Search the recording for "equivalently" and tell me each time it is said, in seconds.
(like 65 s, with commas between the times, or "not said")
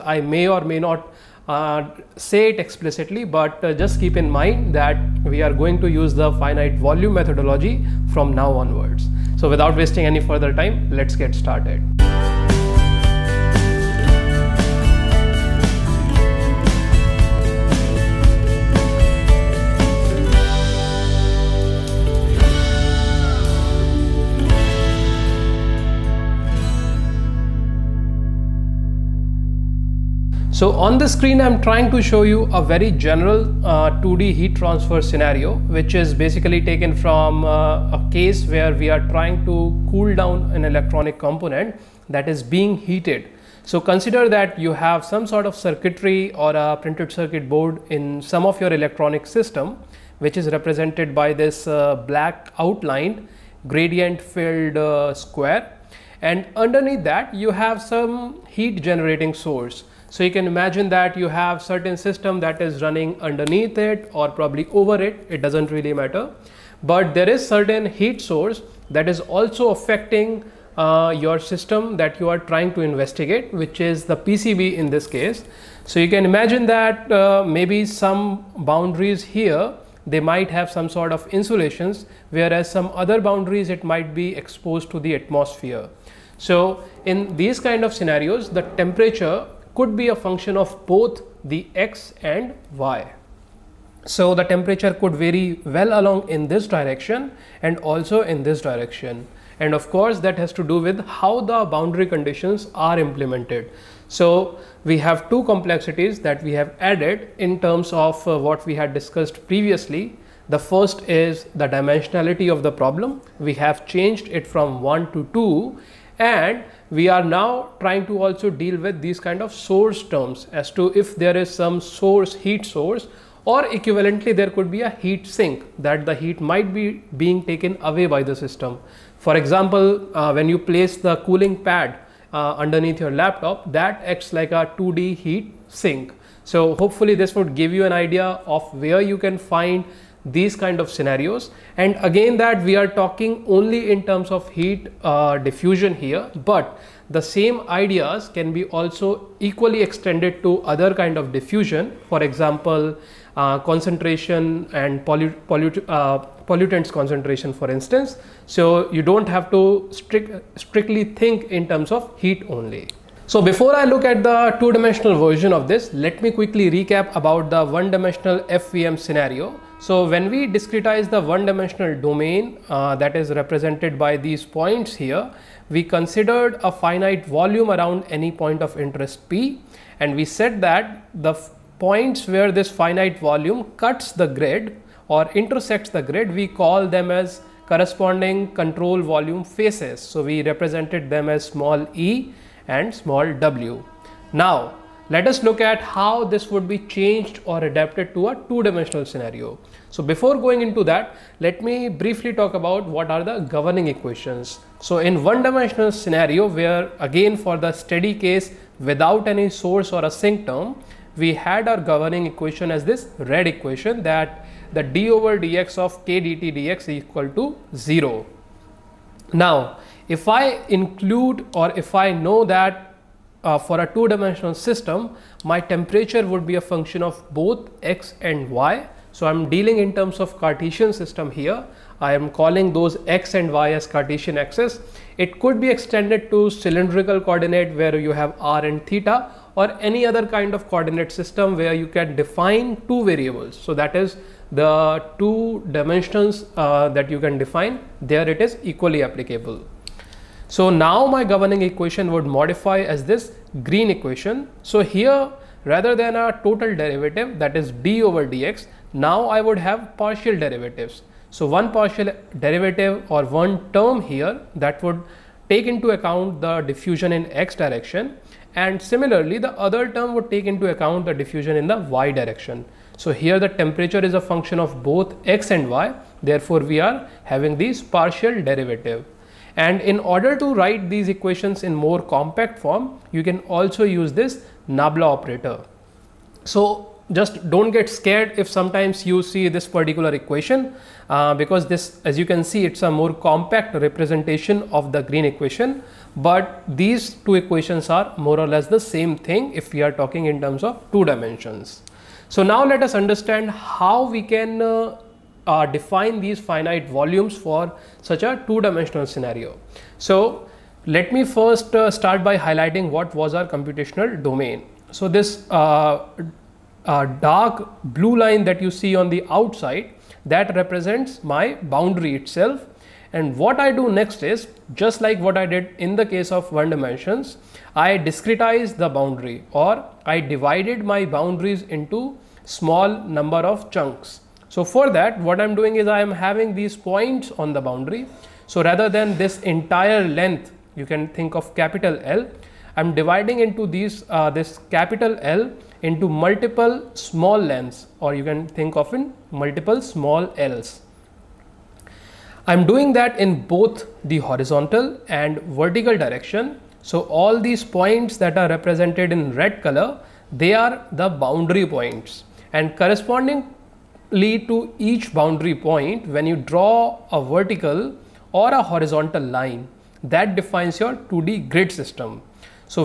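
123 s.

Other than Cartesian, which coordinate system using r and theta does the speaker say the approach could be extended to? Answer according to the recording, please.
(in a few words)
cylindrical.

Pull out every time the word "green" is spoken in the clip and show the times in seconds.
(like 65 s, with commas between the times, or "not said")
253 s, 295 s.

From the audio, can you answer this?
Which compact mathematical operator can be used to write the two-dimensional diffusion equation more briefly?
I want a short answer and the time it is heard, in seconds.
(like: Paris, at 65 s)
Nabla operator, at 284 s.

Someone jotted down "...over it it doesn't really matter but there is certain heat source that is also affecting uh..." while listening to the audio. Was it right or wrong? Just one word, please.
right.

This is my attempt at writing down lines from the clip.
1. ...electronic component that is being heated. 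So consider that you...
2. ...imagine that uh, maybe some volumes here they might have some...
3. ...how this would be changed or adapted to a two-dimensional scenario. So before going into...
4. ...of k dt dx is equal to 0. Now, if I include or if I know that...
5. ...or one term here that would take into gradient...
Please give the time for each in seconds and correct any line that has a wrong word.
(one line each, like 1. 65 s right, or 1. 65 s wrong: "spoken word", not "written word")
1. 40 s right
2. 76 s wrong: "boundaries", not "volumes"
3. 195 s right
4. 215 s right
5. 263 s wrong: "account", not "gradient".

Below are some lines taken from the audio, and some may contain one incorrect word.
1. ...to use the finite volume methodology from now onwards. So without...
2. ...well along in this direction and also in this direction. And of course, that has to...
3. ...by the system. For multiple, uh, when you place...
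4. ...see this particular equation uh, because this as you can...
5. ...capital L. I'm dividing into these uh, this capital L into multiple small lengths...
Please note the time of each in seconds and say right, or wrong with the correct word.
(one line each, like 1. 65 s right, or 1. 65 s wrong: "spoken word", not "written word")
1. 5 s right
2. 95 s right
3. 128 s wrong: "example", not "multiple"
4. 289 s right
5. 341 s right.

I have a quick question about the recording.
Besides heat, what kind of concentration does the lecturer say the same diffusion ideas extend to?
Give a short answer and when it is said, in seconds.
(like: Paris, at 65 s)
pollutants concentration, at 155 s.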